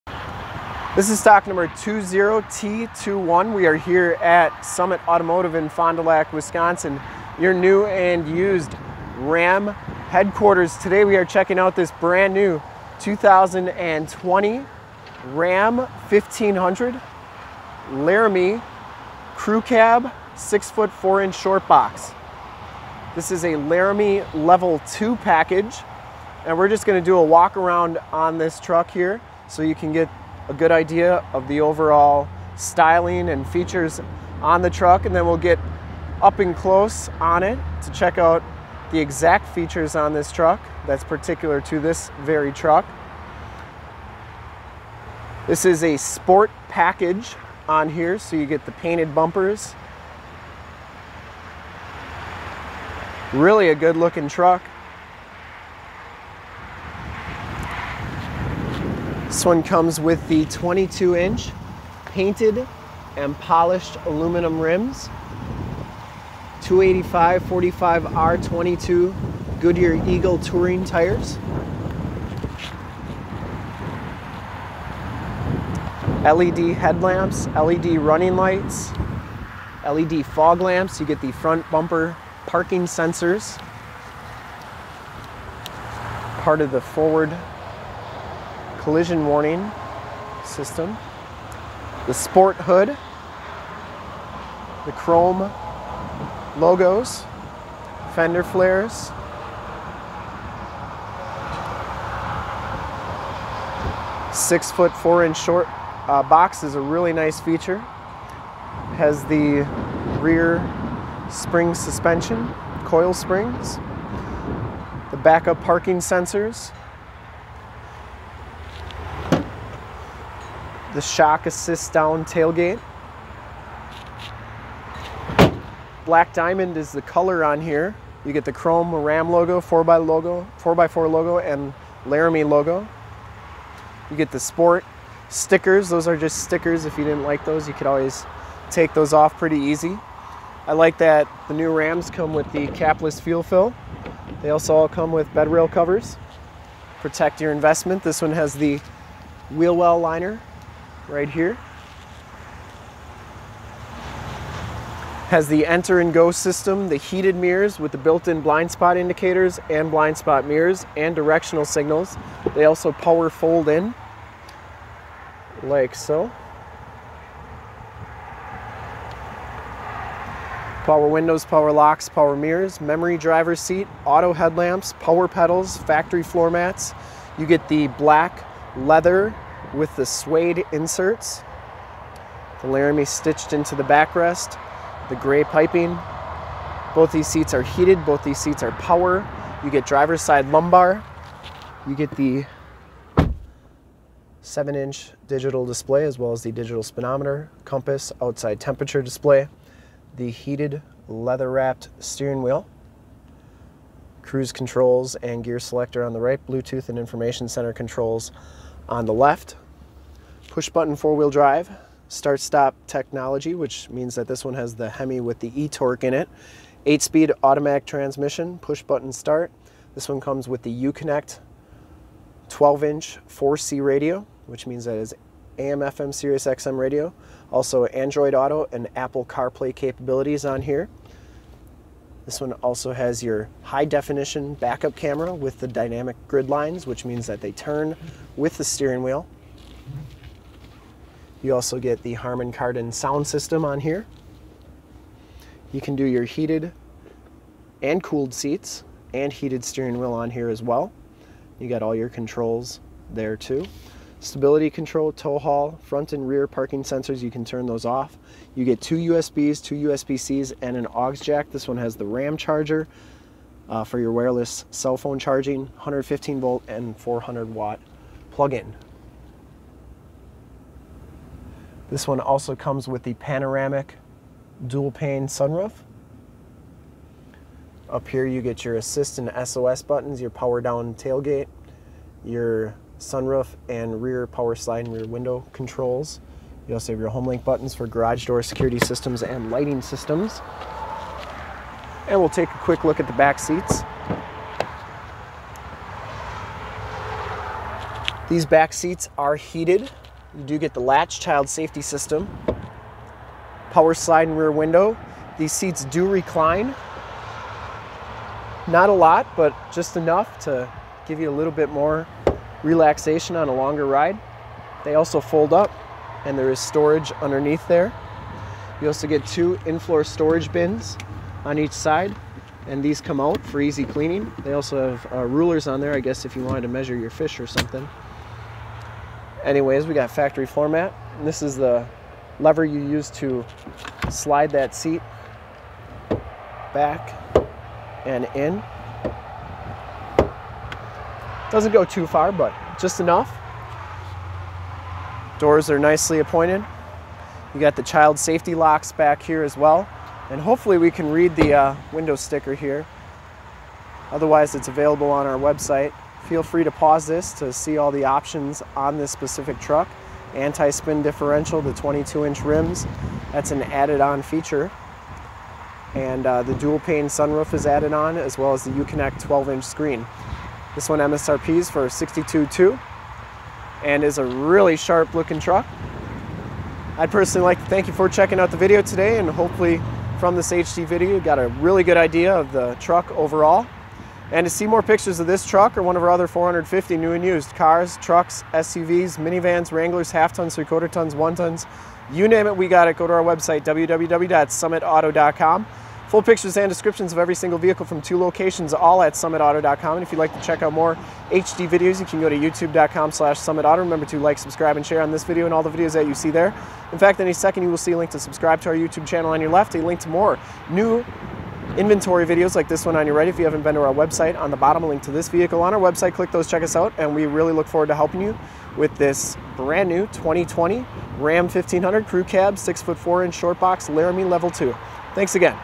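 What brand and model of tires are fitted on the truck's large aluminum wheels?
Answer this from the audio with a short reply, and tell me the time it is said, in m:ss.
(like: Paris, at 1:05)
Goodyear Eagle, at 1:09.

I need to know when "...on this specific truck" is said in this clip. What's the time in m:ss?
5:58.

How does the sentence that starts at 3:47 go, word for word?
Also Android Auto and Apple CarPlay capabilities on here.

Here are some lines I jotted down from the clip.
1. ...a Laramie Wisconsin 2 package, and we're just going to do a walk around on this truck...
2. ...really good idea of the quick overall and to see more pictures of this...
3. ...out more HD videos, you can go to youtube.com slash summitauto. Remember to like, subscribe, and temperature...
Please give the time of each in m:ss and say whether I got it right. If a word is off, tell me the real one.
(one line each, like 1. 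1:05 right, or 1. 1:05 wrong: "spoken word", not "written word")
1. 0:23 wrong: "Level", not "Wisconsin"
2. 6:21 wrong: "truck", not "quick"
3. 6:40 wrong: "share", not "temperature".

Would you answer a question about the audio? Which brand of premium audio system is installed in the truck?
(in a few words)
Harman Kardon.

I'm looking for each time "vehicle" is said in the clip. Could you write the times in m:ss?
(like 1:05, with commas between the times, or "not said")
6:37, 6:55.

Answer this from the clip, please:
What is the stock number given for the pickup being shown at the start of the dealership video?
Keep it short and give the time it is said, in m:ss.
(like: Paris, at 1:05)
20T21, at 0:01.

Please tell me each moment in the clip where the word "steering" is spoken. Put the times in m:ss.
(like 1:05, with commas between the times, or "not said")
3:21, 3:58, 4:09.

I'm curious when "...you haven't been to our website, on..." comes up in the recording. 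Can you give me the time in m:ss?
6:53.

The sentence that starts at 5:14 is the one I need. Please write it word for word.
They also fold up and there is storage underneath there.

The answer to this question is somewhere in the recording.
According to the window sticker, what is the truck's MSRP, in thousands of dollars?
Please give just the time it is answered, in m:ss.
6:11.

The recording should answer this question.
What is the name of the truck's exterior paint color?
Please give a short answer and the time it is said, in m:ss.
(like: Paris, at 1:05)
Black Diamond, at 2:06.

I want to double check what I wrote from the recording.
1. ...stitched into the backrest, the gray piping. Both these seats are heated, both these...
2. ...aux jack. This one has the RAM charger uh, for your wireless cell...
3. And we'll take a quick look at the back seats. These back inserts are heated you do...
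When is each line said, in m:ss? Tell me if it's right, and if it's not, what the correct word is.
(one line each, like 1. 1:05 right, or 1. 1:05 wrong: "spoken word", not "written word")
1. 3:03 right
2. 4:20 right
3. 4:52 wrong: "seats", not "inserts".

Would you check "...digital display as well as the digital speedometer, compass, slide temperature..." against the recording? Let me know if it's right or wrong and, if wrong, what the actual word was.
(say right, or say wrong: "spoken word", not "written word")
wrong: "outside", not "slide".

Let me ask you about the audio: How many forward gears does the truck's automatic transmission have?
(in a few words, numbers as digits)
8.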